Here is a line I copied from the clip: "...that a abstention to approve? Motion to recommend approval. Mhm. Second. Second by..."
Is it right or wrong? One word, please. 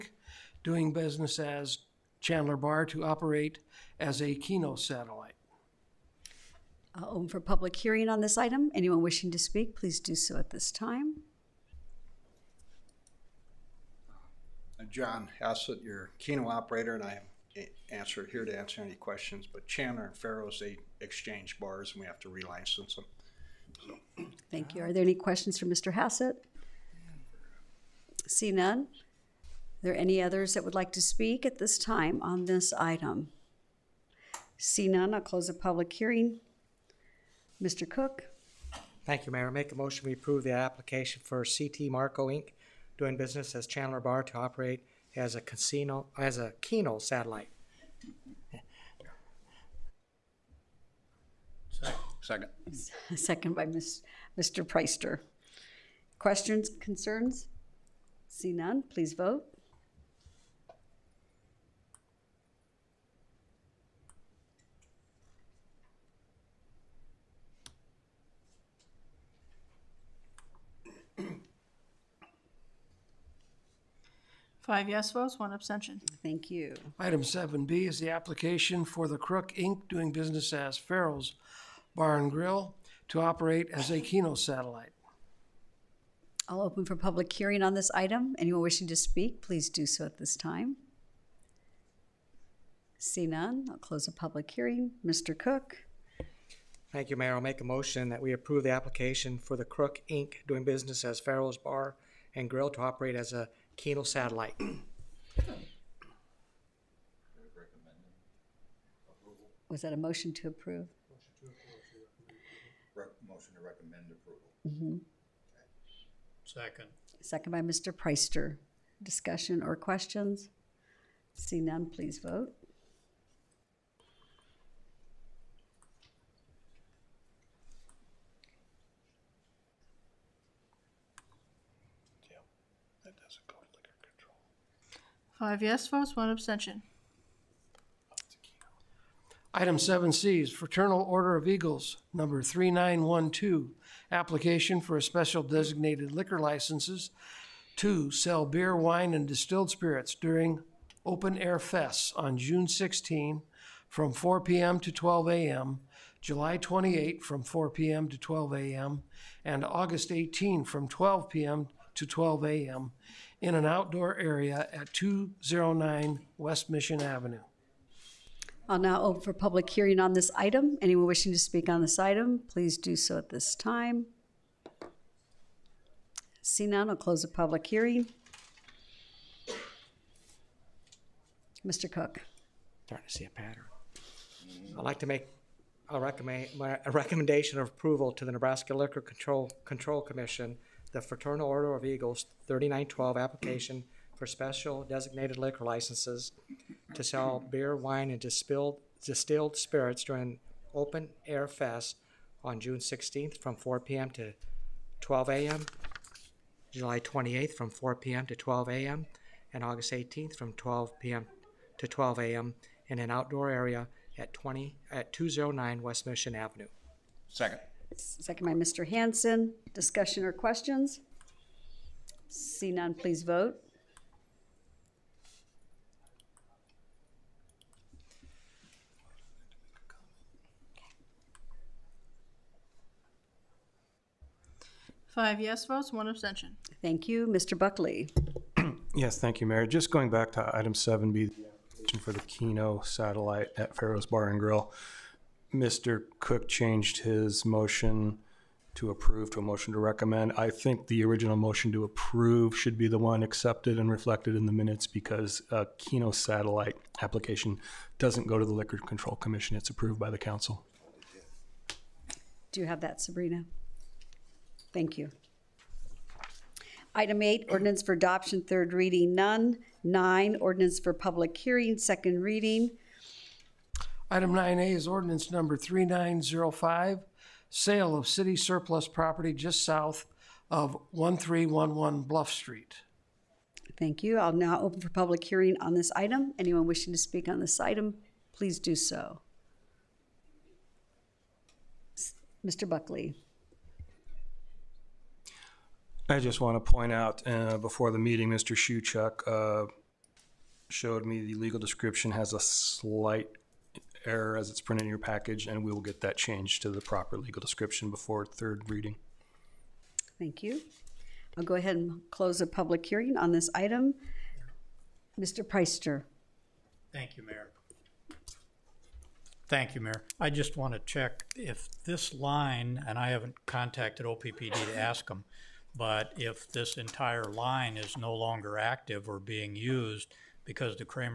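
wrong.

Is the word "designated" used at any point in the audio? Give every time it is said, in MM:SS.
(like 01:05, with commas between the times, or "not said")
02:25, 03:14.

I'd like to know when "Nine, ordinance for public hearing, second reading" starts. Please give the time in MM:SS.
04:29.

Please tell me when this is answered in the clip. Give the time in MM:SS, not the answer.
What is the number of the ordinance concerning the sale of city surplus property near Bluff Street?
04:35.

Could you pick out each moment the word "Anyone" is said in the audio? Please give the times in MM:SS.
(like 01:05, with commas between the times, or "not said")
00:08, 01:28, 02:50, 04:46.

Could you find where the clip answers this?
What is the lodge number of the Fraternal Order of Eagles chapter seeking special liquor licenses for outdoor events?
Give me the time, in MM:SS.
02:22.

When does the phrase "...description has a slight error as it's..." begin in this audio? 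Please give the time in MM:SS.
05:01.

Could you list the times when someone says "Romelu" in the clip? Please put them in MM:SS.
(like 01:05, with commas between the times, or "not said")
not said.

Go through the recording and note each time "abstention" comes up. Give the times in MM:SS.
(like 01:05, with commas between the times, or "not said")
01:15, 02:16, 03:56.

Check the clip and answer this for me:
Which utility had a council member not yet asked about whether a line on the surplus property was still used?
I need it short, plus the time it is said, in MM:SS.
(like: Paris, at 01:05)
OPPD, at 05:24.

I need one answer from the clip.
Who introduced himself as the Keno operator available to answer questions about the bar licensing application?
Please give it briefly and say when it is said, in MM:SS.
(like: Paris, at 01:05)
John Hassett, at 00:14.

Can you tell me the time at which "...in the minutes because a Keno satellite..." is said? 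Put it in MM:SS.
04:14.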